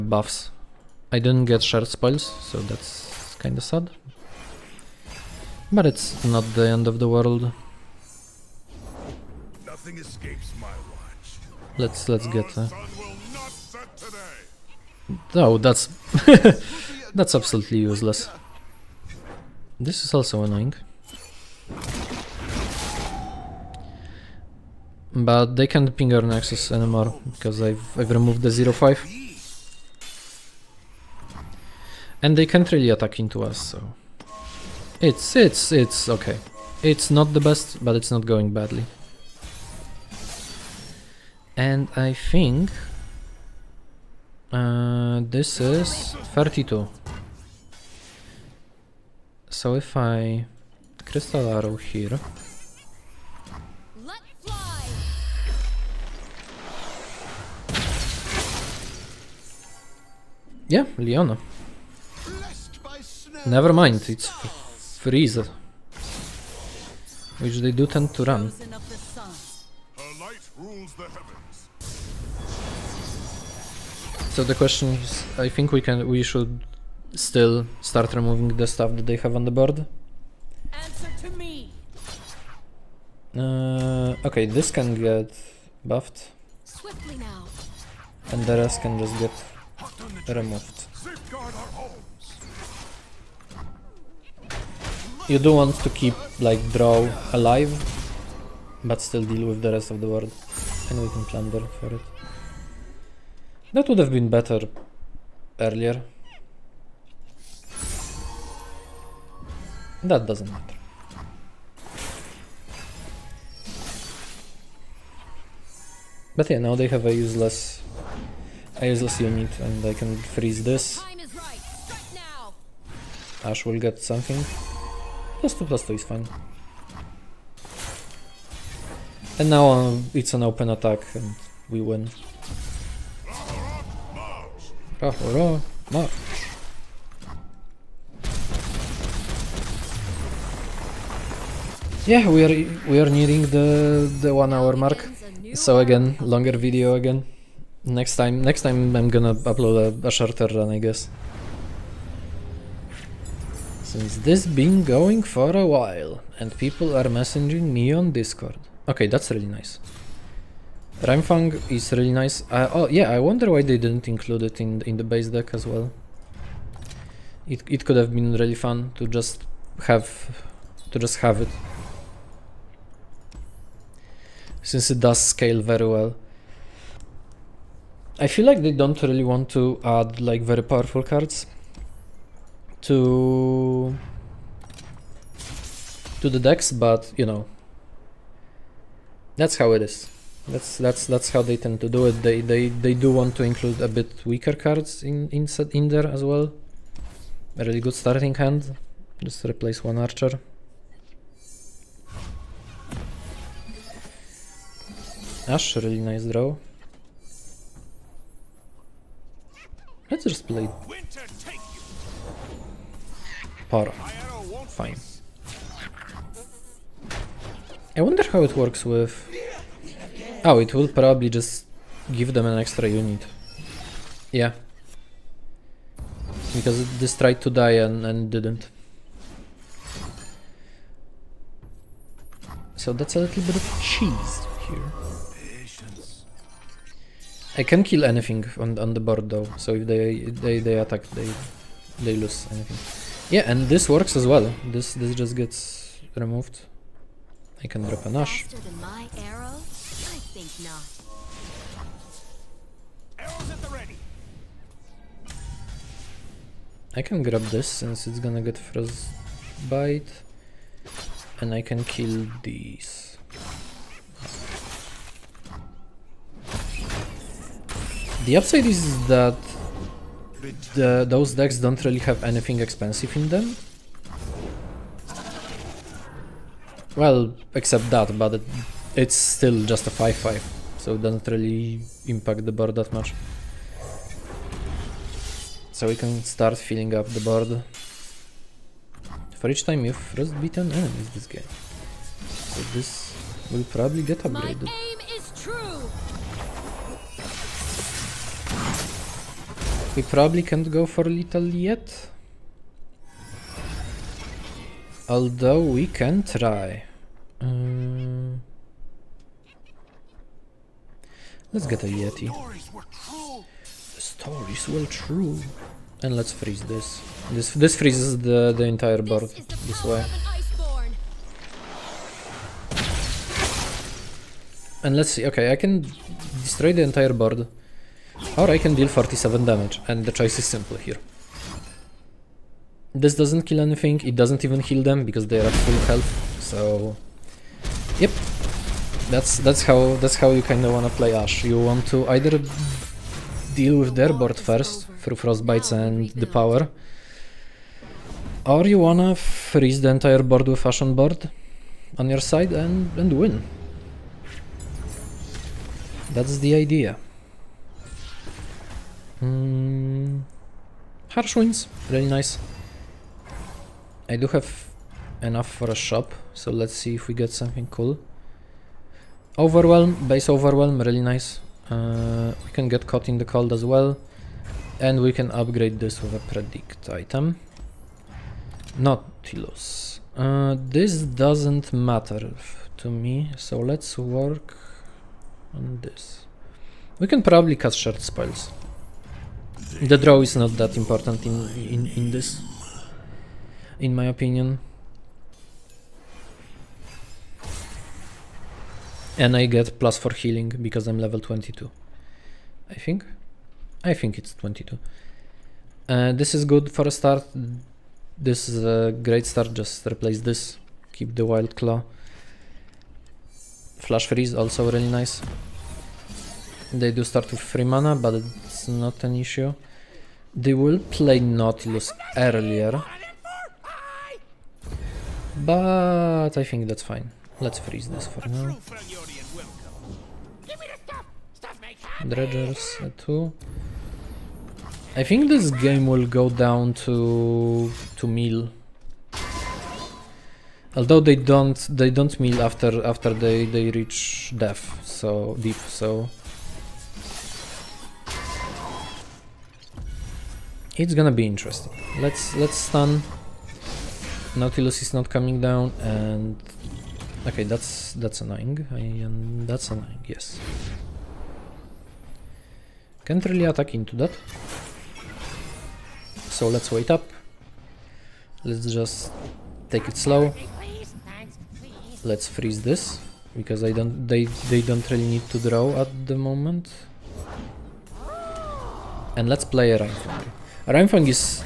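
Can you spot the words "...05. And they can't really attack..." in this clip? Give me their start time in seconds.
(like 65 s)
28 s.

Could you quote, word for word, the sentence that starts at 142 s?
Yeah, we are we are nearing the the one hour mark.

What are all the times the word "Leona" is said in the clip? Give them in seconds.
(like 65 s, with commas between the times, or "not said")
60 s.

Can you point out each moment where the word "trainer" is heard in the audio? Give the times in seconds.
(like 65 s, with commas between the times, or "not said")
not said.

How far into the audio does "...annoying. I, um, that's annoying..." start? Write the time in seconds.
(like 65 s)
458 s.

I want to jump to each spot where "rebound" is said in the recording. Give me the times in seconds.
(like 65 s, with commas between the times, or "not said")
not said.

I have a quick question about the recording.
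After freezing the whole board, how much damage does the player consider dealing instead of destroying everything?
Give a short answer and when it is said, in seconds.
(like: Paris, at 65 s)
47, at 328 s.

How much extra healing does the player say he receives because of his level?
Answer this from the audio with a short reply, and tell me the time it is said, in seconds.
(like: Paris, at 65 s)
plus 4, at 399 s.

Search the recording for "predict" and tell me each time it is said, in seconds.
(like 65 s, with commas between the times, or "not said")
376 s.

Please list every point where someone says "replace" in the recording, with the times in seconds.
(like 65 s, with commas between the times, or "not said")
199 s, 409 s.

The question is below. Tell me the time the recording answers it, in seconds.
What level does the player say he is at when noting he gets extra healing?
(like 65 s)
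400 s.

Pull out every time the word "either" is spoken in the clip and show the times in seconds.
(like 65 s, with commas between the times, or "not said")
342 s.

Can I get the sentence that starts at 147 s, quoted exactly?
Next time, next time I'm gonna upload a, a shorter run, I guess.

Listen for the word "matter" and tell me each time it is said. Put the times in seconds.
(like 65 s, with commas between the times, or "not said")
110 s, 381 s.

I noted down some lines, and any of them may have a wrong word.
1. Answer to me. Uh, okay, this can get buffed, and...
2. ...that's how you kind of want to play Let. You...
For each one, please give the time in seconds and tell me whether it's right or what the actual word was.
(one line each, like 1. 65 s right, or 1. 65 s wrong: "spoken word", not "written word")
1. 80 s right
2. 340 s wrong: "Ashe", not "Let".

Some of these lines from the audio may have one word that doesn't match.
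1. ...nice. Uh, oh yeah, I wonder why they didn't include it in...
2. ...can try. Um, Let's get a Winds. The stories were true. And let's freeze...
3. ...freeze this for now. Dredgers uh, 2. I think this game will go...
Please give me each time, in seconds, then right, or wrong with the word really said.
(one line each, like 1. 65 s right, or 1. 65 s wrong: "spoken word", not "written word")
1. 162 s right
2. 305 s wrong: "Yeti", not "Winds"
3. 427 s right.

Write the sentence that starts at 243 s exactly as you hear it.
Yeah, and this works as well.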